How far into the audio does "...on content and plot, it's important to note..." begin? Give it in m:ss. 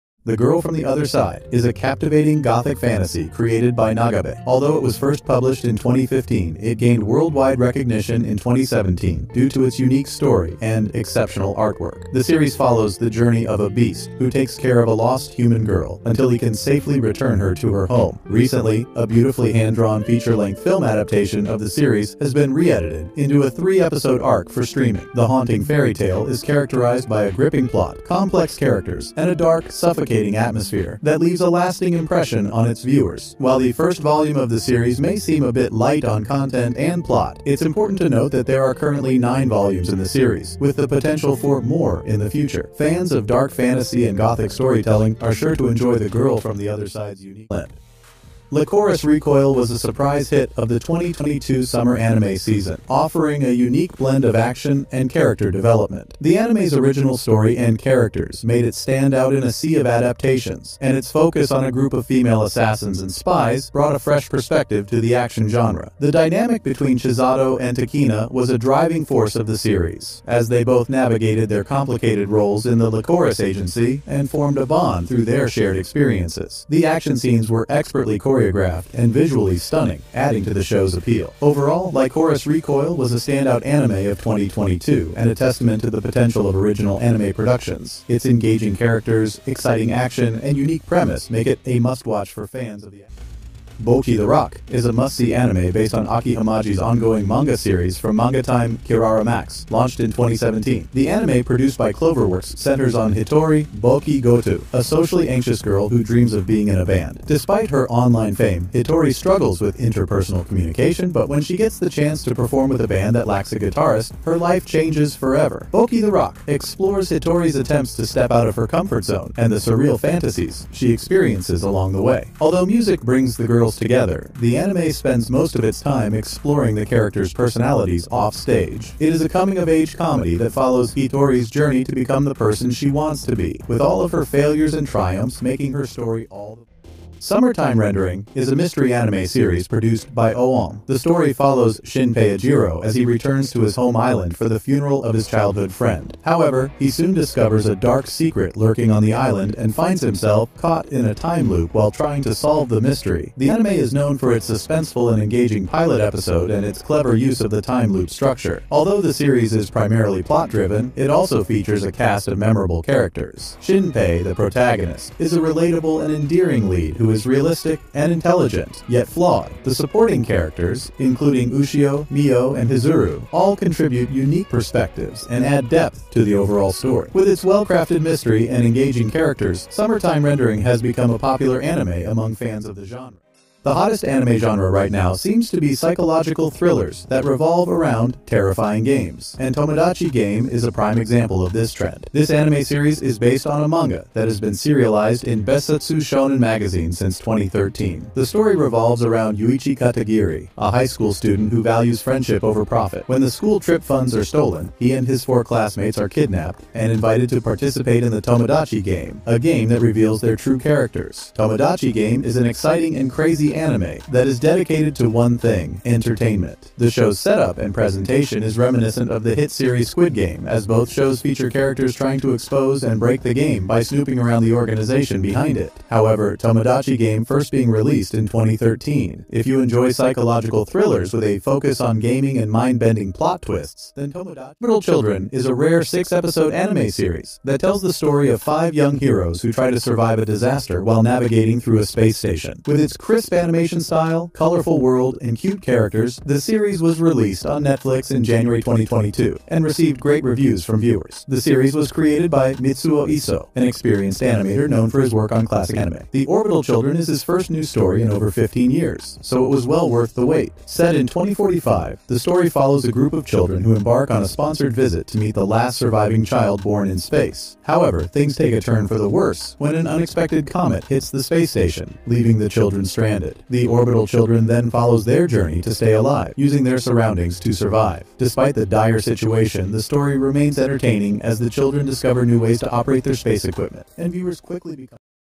0:36.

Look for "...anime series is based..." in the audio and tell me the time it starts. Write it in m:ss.
3:12.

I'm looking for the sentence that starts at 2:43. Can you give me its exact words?
Shinpei, the protagonist, is a relatable and endearing lead who is realistic and intelligent, yet flawed.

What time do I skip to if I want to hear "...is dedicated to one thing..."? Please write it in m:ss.
3:34.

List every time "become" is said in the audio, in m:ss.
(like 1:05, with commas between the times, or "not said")
2:11, 3:00, 4:44.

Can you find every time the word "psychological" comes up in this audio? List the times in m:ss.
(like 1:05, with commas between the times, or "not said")
3:05, 3:49.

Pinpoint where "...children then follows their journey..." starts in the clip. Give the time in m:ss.
4:34.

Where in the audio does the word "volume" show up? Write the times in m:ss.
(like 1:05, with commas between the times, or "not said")
0:34, 0:39.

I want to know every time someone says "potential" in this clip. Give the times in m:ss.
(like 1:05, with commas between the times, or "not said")
0:40, 1:26.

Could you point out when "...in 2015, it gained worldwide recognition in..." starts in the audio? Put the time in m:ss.
0:05.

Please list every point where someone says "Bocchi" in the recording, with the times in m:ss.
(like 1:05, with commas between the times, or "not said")
1:33, 1:43, 1:55.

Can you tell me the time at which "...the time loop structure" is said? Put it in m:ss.
2:37.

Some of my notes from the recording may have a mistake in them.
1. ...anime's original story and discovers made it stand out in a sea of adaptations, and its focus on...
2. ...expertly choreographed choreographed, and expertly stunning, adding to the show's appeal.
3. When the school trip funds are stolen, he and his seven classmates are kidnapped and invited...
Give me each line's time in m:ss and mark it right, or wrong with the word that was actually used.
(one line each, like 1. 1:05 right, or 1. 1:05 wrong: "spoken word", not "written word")
1. 0:56 wrong: "characters", not "discovers"
2. 1:17 wrong: "visually", not "expertly"
3. 3:23 wrong: "four", not "seven".